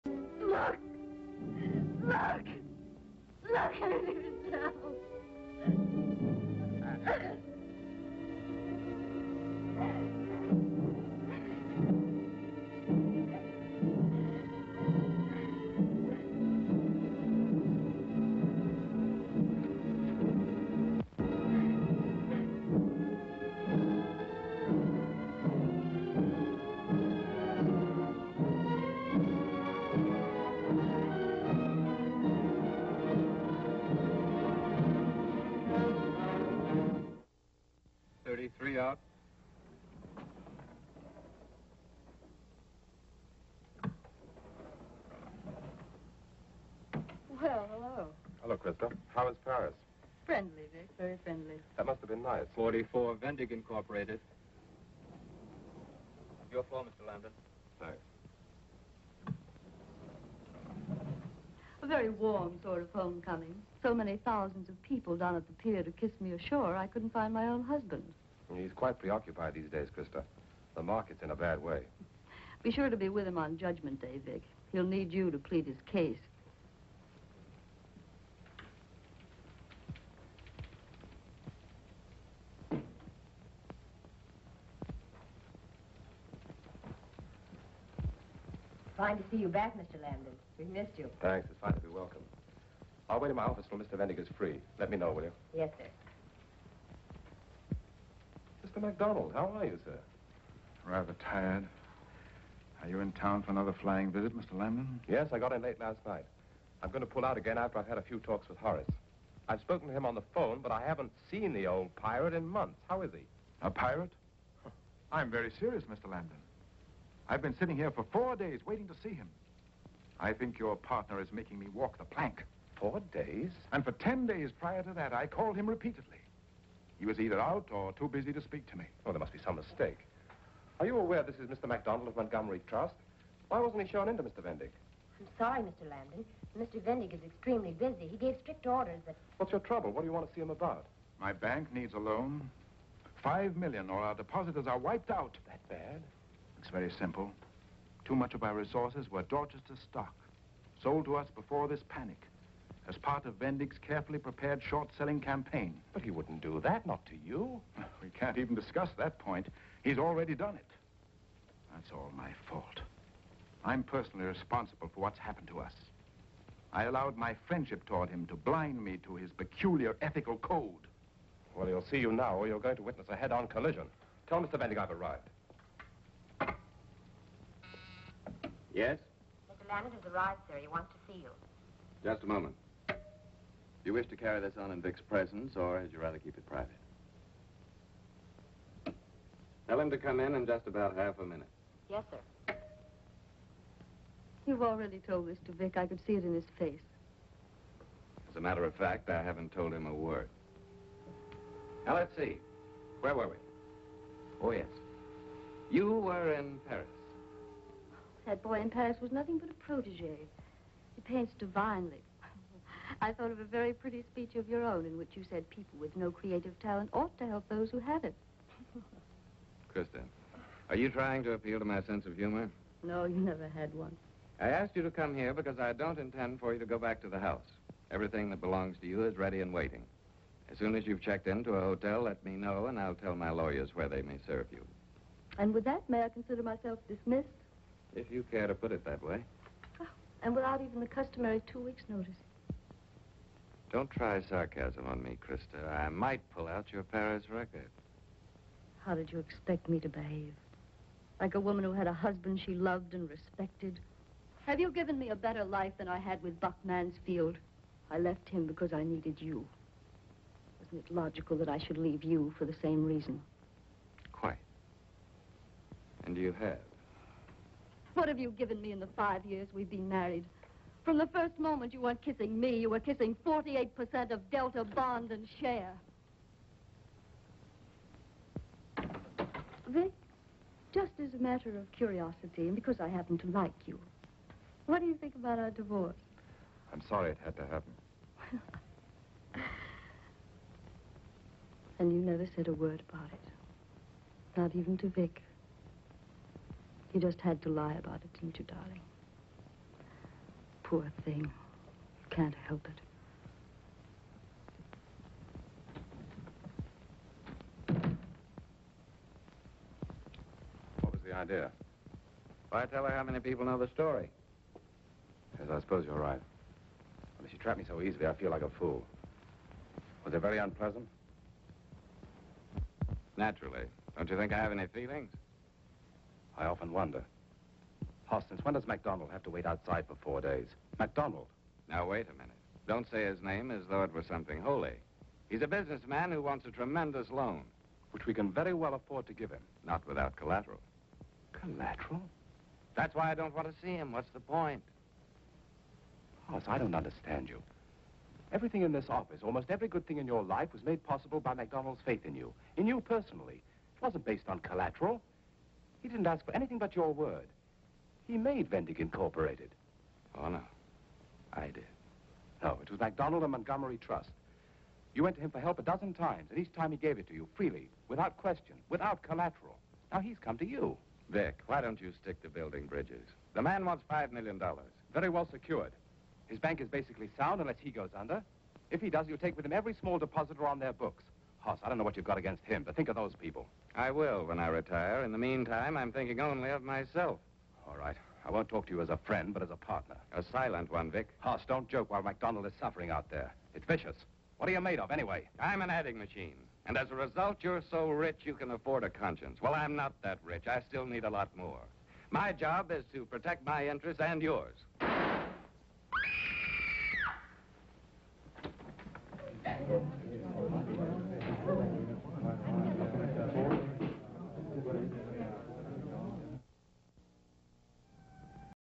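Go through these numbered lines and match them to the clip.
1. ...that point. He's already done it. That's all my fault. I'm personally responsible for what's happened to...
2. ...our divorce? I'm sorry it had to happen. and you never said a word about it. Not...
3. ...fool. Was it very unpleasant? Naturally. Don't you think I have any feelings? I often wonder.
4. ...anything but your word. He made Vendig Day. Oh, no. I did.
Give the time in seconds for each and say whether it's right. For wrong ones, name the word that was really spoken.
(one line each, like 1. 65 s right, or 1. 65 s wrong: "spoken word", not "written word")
1. 158 s right
2. 285 s right
3. 318 s right
4. 356 s wrong: "Incorporated", not "Day".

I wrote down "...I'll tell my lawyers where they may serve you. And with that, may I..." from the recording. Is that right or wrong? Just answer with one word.
right.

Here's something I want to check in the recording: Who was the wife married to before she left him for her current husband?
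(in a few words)
Buck Mansfield.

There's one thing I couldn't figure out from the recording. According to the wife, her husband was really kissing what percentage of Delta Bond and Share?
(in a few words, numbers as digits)
48%.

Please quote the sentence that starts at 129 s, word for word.
Oh, there must be some mistake.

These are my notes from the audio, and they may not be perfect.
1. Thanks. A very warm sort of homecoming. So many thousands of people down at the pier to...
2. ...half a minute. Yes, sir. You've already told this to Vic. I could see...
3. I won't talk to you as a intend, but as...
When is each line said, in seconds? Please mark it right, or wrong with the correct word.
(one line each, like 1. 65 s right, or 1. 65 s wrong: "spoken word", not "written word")
1. 57 s right
2. 190 s right
3. 388 s wrong: "friend", not "intend".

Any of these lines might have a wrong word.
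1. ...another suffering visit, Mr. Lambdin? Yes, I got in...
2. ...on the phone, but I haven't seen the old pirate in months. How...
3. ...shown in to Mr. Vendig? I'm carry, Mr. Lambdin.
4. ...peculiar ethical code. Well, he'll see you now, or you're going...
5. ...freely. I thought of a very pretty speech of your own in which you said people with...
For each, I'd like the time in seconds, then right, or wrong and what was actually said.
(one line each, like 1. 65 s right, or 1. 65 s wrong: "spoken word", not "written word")
1. 103 s wrong: "flying", not "suffering"
2. 110 s right
3. 133 s wrong: "sorry", not "carry"
4. 169 s right
5. 211 s wrong: "divinely", not "freely".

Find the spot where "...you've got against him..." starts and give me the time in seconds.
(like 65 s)
381 s.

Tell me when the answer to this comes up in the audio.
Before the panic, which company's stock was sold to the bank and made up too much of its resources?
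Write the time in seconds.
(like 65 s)
149 s.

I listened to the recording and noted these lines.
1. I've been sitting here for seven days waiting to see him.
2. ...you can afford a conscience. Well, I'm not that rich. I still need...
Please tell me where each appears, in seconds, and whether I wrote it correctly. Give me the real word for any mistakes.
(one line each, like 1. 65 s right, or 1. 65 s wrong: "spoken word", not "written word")
1. 117 s wrong: "four", not "seven"
2. 398 s right.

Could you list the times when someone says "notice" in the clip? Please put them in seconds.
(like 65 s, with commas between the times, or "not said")
241 s.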